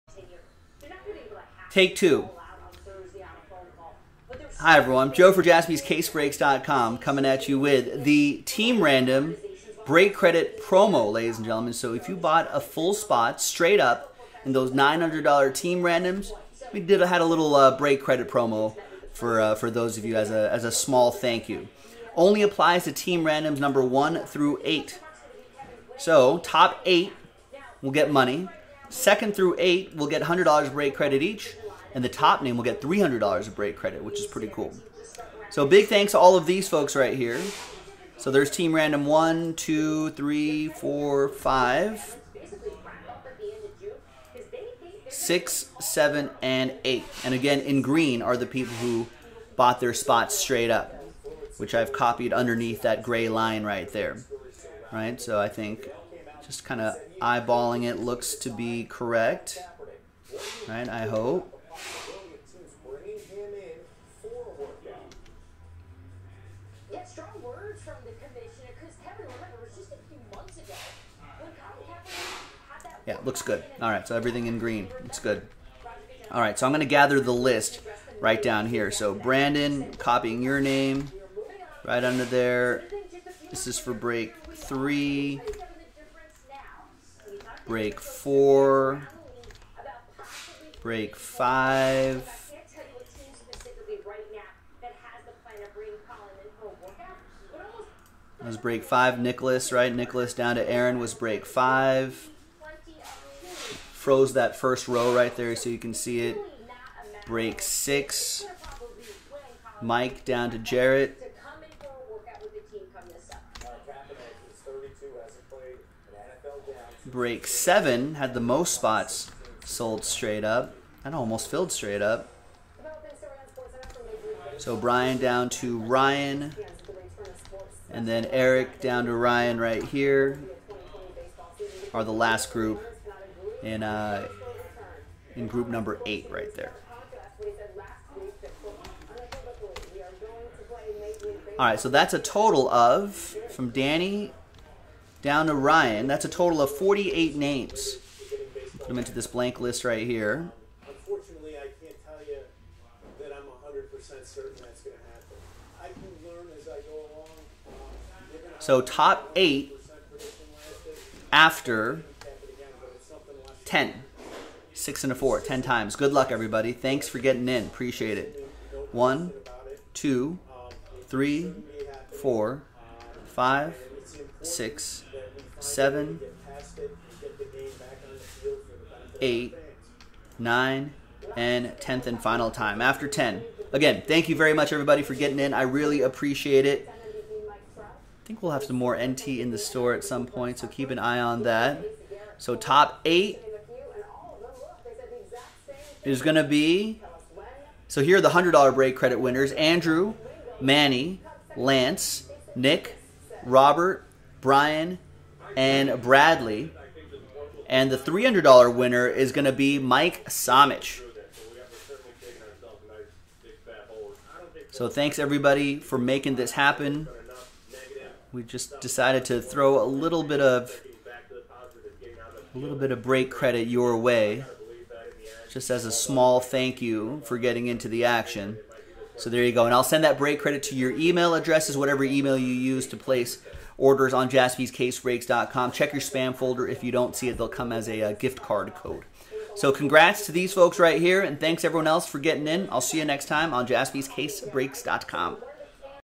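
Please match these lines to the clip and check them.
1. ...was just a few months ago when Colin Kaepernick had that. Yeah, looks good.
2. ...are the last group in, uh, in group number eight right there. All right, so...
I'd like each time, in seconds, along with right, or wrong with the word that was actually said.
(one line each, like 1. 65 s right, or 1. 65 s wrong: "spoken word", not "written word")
1. 69 s right
2. 131 s right.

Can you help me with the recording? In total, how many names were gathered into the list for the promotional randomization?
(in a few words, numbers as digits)
48.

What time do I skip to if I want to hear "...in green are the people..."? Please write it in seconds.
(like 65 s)
47 s.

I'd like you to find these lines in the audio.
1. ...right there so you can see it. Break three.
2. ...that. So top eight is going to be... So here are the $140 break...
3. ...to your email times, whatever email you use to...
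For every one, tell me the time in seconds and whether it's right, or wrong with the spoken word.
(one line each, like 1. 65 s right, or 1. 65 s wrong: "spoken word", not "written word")
1. 105 s wrong: "six", not "three"
2. 191 s wrong: "100", not "140"
3. 230 s wrong: "addresses", not "times".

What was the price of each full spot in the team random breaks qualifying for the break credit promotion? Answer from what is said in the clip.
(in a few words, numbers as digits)
$900.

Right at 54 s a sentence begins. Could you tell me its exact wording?
Right, so I think just kind of eyeballing it looks to be correct.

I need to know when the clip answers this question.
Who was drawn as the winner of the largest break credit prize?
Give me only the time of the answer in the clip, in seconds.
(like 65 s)
209 s.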